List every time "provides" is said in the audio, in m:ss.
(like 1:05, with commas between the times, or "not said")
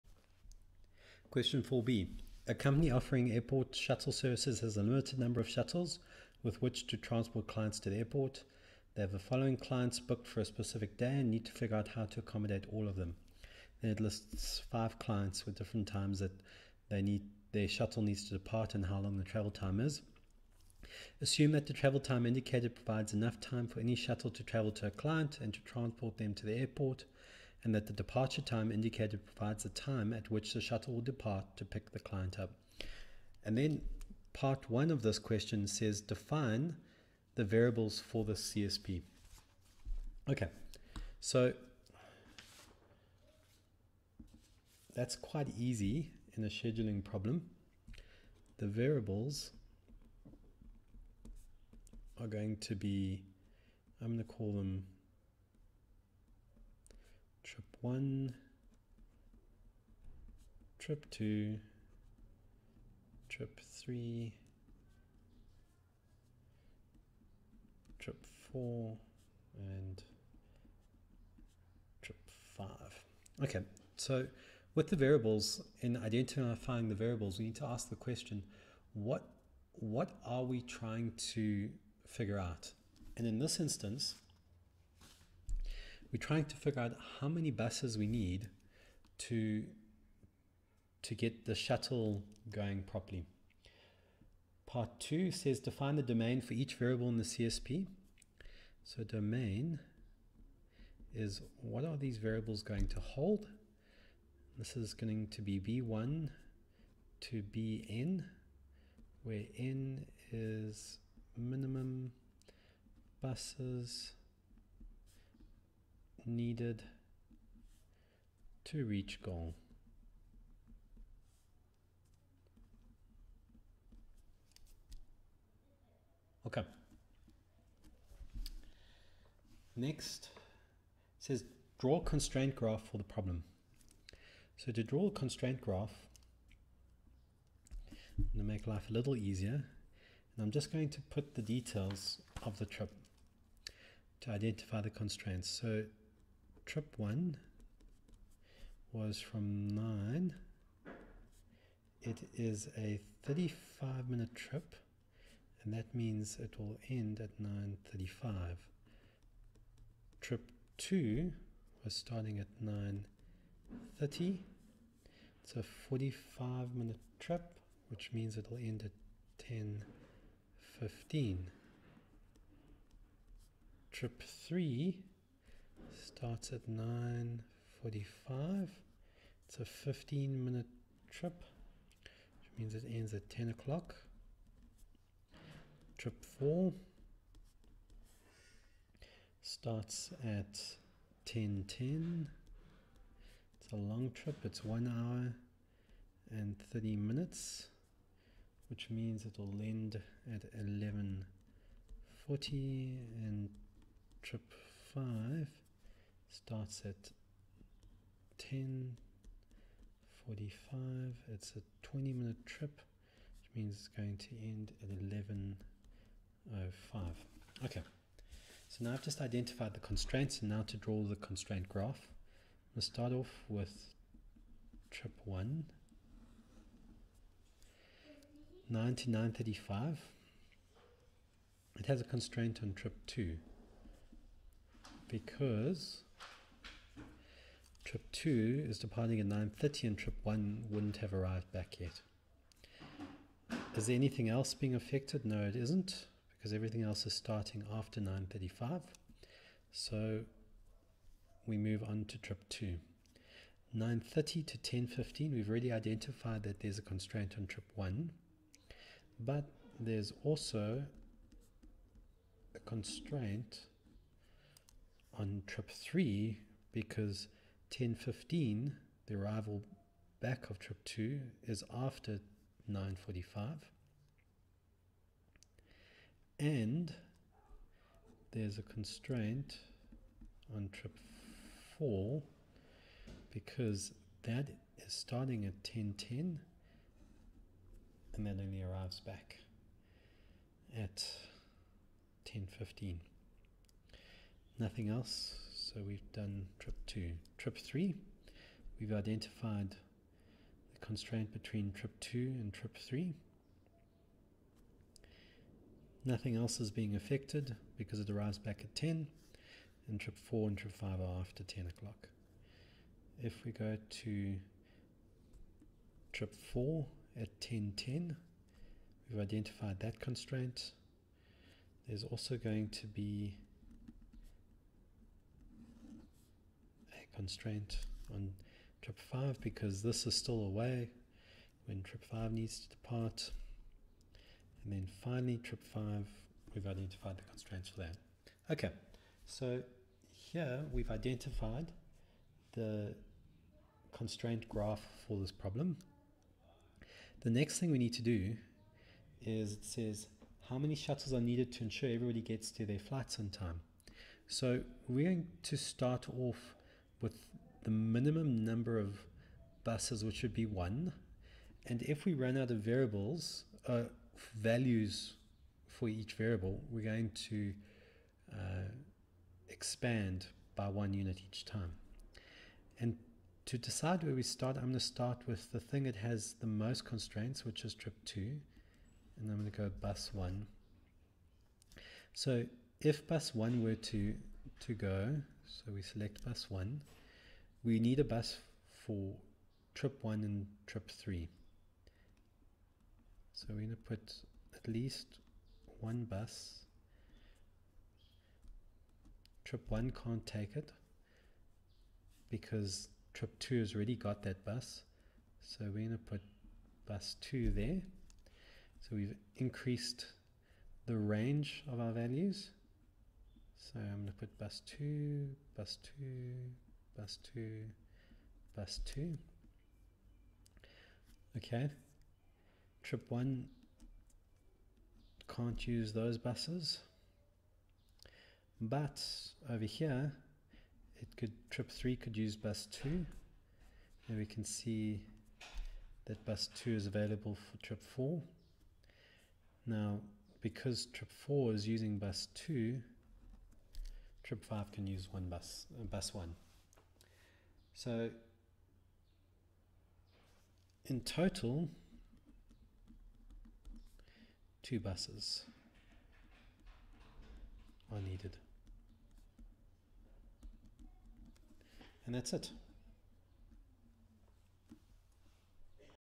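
0:22, 0:29.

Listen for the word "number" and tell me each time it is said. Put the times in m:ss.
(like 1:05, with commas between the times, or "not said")
0:05, 5:58.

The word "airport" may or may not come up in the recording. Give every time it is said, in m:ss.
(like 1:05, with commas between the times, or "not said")
0:03, 0:07, 0:26.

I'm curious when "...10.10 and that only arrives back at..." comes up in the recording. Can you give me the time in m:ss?
4:45.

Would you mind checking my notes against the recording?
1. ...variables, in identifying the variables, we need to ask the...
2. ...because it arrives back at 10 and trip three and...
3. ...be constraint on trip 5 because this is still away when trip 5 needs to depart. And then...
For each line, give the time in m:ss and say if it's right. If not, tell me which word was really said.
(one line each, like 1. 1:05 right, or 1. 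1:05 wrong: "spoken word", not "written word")
1. 1:14 right
2. 5:07 wrong: "four", not "three"
3. 5:22 right.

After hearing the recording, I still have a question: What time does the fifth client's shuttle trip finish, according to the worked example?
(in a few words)
11:05.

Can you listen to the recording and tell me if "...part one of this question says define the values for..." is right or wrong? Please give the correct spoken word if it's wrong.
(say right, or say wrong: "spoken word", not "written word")
wrong: "variables", not "values".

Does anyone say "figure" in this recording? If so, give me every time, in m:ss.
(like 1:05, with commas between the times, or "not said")
0:11, 1:22, 1:26.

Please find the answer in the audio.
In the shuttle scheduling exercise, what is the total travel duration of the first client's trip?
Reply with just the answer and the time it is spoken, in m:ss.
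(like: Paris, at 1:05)
35 minutes, at 2:33.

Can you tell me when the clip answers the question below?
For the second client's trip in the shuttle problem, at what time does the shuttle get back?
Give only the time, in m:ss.
2:48.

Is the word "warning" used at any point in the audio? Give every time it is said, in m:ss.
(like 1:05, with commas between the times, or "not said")
not said.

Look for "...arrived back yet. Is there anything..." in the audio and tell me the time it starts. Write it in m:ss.
4:01.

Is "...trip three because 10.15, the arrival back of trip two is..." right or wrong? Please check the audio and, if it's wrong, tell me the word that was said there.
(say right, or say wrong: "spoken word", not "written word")
right.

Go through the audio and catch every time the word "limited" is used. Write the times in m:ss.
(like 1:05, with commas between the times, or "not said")
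0:04.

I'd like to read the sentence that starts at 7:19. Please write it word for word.
Now, because trip 4 is using bus 2, Trip 5 can use one bus, uh, bus 1.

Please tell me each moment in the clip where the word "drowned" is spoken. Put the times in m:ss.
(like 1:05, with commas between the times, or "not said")
not said.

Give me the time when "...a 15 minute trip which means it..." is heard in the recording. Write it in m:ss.
2:59.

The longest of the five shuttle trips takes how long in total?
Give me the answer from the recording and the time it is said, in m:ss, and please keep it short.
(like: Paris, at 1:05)
1 hour 30 minutes, at 3:14.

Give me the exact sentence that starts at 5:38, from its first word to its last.
Okay, so here we've identified the constraint graph for this problem.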